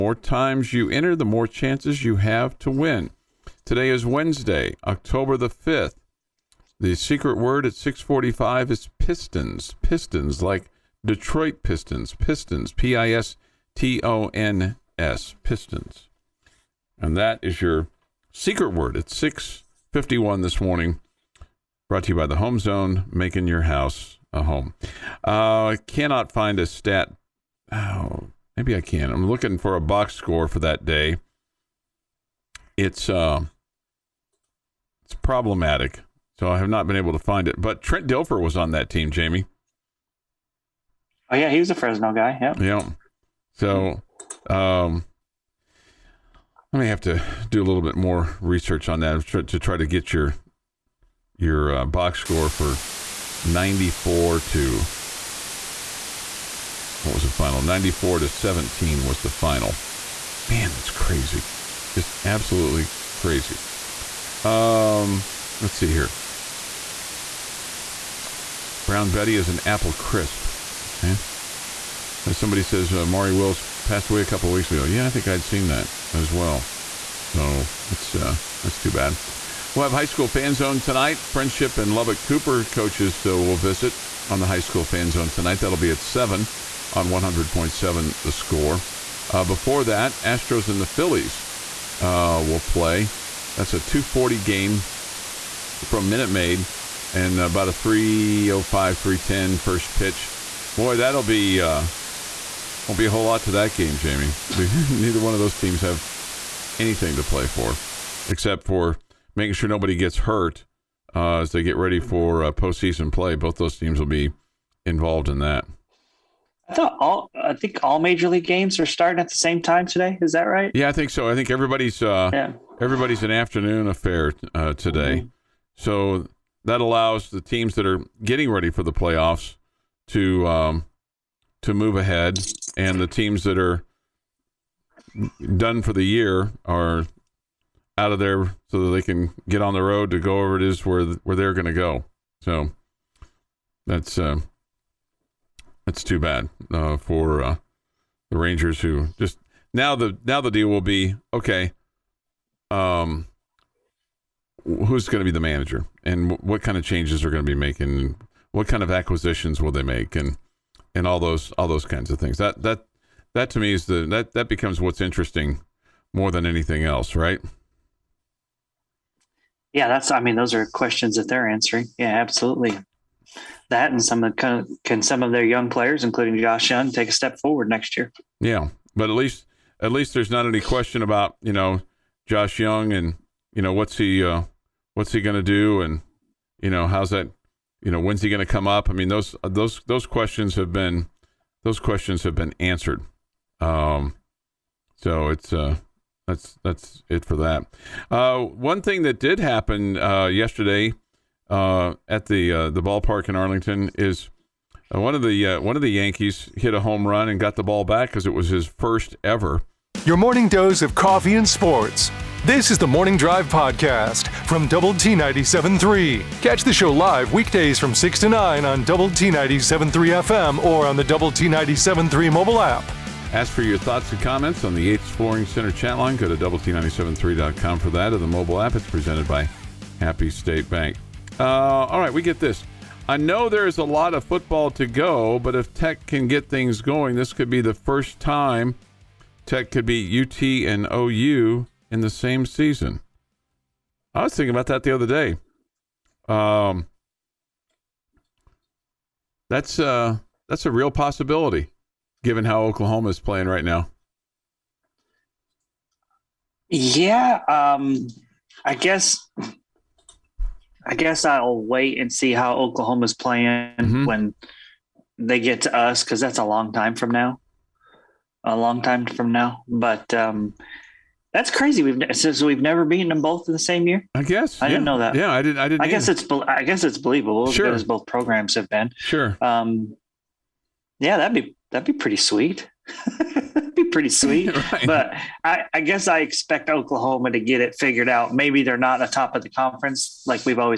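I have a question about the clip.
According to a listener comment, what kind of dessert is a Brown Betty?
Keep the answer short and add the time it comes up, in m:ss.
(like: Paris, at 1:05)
apple crisp, at 1:09.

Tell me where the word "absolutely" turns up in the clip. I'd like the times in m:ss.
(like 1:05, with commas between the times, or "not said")
1:02, 2:52.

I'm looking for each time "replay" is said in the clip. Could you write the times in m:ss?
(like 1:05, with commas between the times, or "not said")
not said.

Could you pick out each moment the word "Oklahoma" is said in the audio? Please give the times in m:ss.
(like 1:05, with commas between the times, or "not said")
4:12, 4:22, 4:46.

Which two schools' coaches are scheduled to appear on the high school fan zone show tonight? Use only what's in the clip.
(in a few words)
Friendship and Lubbock Cooper.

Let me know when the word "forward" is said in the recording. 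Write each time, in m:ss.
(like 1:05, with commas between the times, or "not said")
2:57.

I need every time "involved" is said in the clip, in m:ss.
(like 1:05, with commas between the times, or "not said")
1:54.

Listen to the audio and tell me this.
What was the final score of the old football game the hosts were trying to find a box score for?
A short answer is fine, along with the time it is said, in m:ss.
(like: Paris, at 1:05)
94 to 17, at 0:57.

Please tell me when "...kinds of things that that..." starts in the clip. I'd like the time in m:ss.
2:41.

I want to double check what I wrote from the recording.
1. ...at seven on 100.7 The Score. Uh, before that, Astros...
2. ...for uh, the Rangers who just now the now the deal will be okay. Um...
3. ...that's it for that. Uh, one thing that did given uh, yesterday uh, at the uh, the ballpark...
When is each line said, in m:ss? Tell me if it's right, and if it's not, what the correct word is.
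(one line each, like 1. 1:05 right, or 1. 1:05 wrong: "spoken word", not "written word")
1. 1:25 right
2. 2:26 right
3. 3:16 wrong: "happen", not "given".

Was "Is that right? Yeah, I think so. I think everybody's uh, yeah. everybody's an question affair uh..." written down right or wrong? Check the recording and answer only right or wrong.
wrong.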